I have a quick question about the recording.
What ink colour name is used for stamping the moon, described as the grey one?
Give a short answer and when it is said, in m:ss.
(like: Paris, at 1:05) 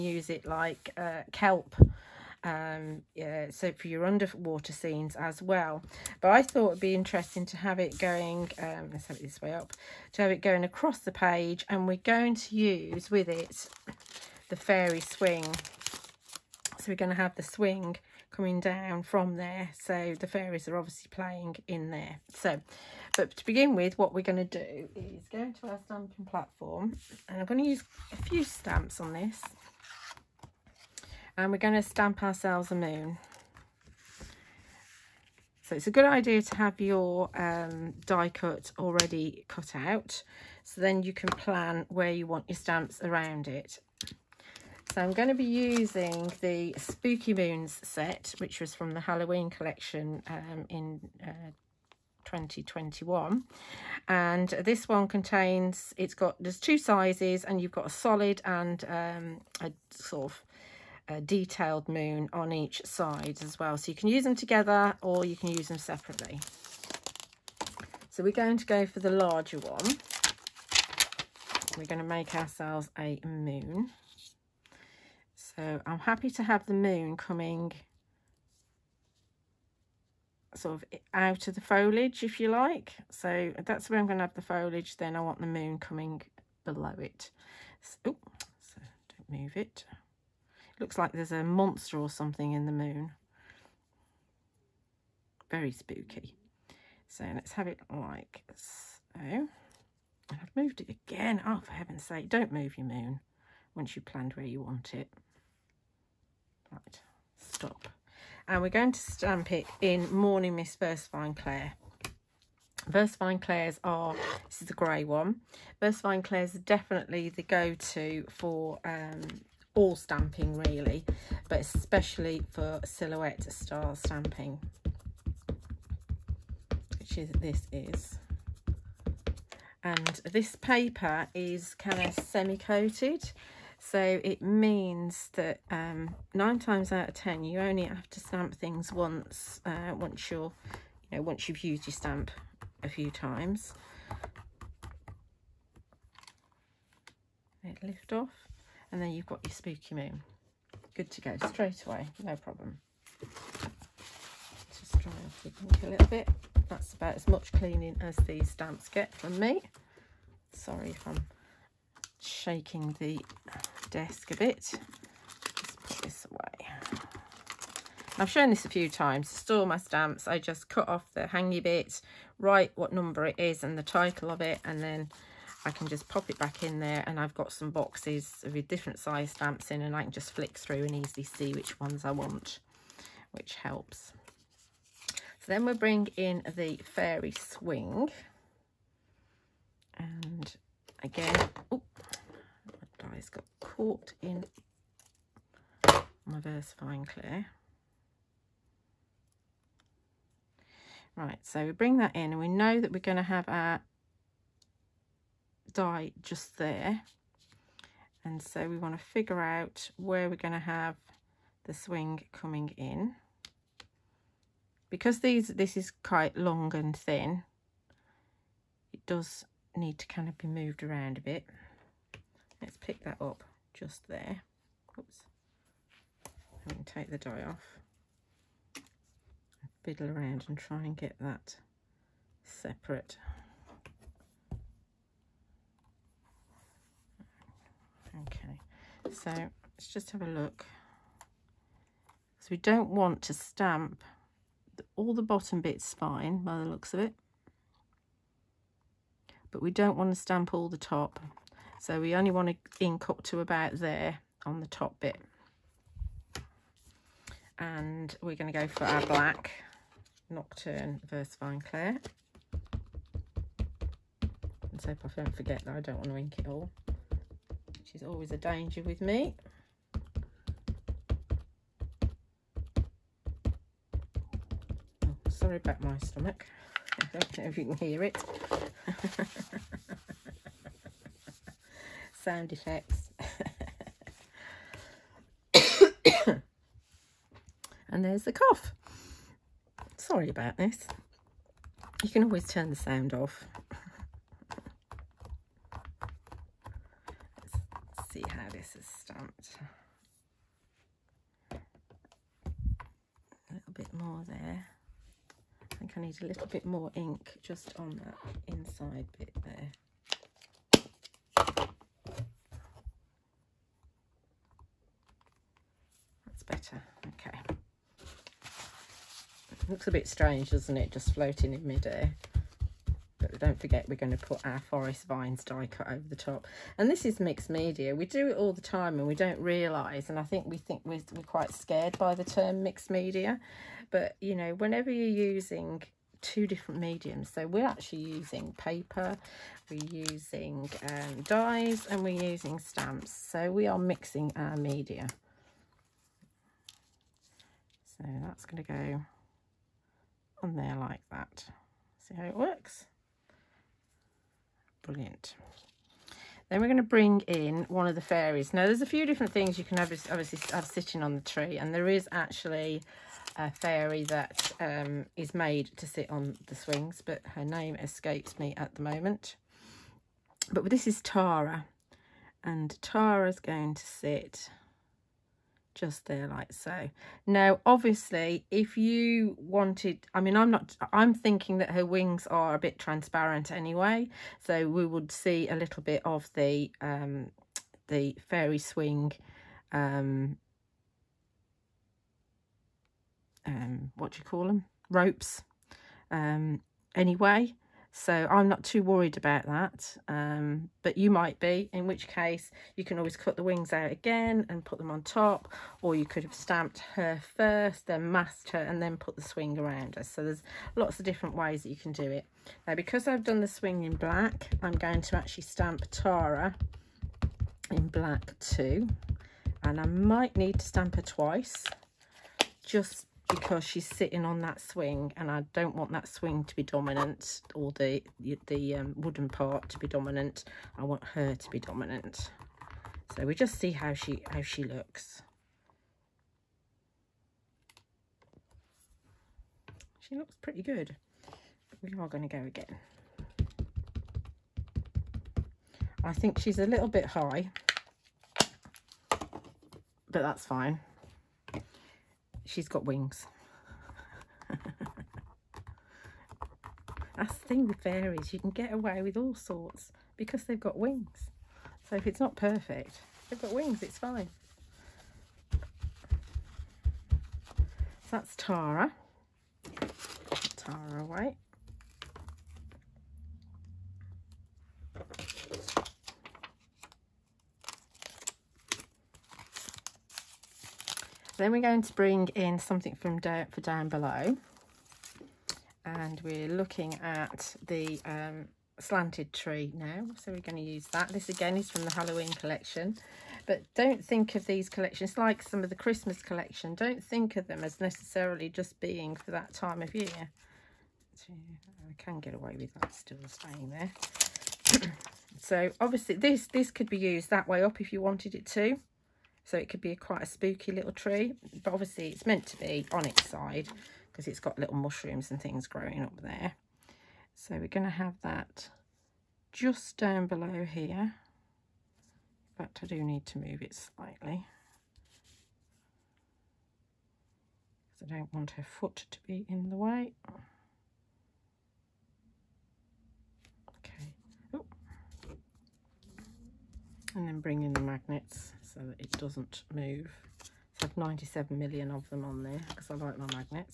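Morning Mist, at 1:50.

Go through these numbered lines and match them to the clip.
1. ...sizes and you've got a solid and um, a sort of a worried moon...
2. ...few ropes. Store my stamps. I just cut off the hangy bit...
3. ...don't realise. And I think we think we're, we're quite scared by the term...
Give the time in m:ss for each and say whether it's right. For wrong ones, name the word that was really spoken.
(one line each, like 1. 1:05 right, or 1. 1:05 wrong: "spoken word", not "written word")
1. 0:56 wrong: "detailed", not "worried"
2. 2:48 wrong: "times", not "ropes"
3. 5:29 right.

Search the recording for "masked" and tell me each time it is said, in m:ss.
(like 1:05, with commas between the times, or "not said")
6:48.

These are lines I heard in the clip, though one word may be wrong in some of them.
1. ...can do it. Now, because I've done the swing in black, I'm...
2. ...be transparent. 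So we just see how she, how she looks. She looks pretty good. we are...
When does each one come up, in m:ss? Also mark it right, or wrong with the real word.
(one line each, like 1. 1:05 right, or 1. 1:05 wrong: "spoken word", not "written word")
1. 6:51 right
2. 7:11 wrong: "dominant", not "transparent".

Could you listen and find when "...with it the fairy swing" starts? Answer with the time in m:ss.
0:13.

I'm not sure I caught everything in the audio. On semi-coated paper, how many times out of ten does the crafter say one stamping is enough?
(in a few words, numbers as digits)
9.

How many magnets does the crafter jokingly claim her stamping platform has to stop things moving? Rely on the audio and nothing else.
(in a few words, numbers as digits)
97 million.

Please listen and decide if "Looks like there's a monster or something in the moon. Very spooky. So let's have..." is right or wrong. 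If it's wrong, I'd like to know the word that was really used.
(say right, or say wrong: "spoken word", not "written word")
right.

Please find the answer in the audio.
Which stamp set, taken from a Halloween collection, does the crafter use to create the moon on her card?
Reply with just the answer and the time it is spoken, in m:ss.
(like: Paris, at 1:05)
Spooky Moons, at 0:46.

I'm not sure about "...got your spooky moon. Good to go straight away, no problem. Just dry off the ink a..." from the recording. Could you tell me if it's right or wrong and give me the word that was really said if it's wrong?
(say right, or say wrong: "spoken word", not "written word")
right.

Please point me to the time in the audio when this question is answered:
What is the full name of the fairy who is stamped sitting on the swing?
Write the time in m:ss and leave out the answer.
7:50.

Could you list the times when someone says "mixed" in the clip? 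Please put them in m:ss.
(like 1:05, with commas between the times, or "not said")
5:27, 5:32.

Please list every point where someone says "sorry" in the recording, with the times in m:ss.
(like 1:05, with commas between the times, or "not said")
2:40, 4:35, 4:49.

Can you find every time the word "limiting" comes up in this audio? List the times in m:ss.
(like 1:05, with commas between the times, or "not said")
not said.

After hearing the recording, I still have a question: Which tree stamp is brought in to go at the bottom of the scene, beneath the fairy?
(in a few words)
slanted tree.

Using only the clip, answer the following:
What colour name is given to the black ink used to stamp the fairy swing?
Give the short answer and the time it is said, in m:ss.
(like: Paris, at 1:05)
Nocturne, at 4:20.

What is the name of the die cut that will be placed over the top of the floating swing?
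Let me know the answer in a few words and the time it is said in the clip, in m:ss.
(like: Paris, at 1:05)
forest vines, at 5:24.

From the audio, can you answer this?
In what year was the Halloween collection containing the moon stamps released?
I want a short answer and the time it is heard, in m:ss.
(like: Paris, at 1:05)
2021, at 0:52.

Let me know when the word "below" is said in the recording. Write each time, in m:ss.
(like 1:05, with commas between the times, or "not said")
1:26, 8:03, 8:40.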